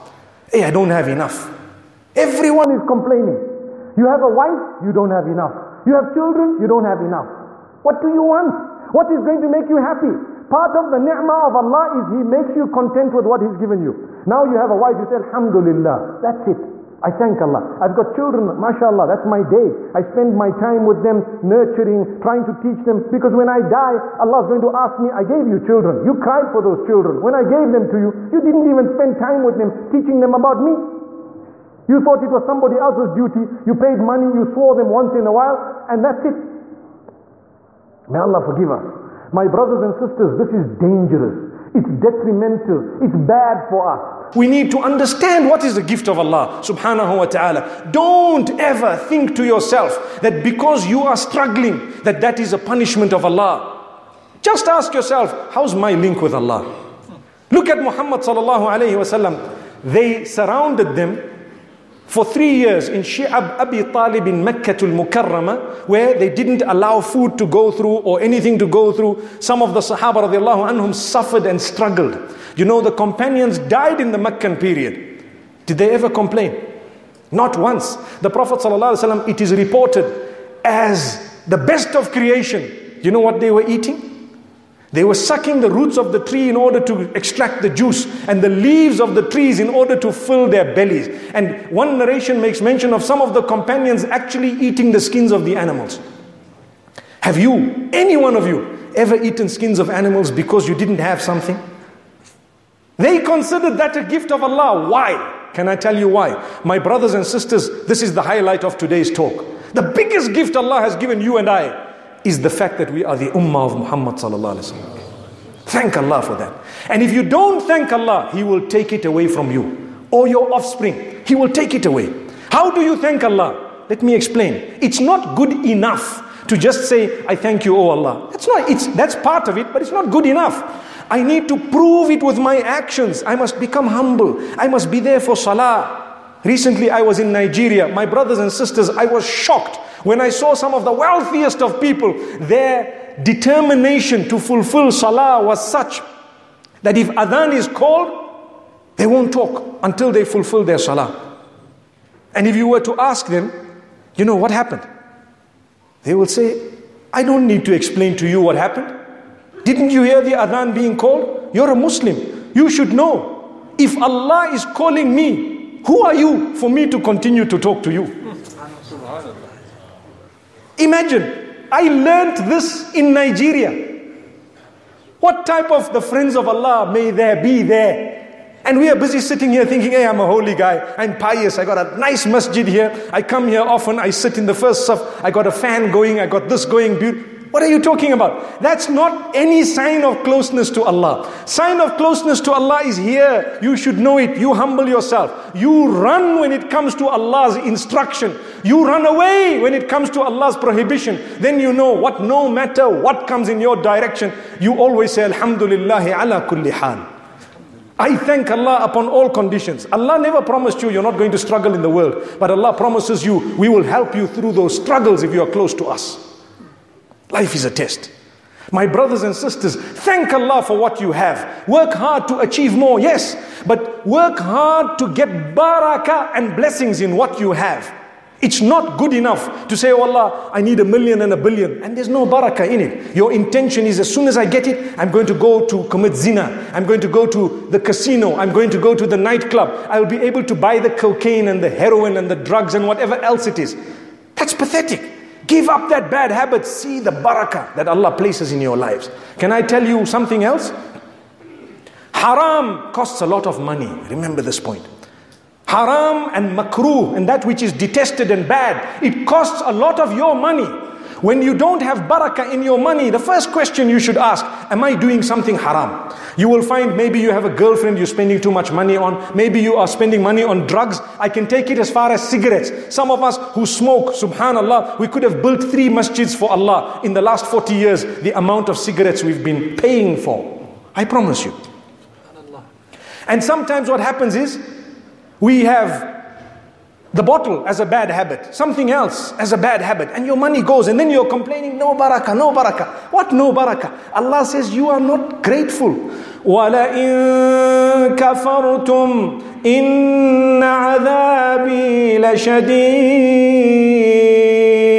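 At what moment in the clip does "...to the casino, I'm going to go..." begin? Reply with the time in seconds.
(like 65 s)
237 s.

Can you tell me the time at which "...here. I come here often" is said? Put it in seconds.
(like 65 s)
182 s.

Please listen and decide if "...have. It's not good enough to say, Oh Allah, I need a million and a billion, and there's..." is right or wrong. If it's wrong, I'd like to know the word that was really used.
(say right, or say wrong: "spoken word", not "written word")
right.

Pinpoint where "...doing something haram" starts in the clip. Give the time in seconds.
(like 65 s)
264 s.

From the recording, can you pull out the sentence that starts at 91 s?
And one narration makes mention of some of the companions actually eating the skins of the animals.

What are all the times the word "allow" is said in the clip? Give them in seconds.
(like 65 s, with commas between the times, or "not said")
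66 s.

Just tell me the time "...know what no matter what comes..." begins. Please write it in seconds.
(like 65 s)
201 s.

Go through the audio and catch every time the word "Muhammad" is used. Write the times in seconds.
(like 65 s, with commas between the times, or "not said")
57 s, 113 s.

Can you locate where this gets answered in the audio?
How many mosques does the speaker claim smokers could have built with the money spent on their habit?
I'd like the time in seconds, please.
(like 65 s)
275 s.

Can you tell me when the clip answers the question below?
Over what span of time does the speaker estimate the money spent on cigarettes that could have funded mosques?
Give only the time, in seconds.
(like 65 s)
277 s.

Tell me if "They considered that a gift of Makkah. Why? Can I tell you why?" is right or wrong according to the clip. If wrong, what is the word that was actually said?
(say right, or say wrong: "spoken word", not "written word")
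wrong: "Allah", not "Makkah".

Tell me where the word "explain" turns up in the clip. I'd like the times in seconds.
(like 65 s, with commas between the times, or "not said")
124 s, 157 s.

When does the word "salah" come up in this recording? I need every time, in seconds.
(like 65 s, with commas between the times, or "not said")
135 s, 144 s, 150 s.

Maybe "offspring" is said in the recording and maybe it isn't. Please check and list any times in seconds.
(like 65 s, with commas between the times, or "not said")
120 s.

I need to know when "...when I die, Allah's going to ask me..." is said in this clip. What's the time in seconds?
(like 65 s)
23 s.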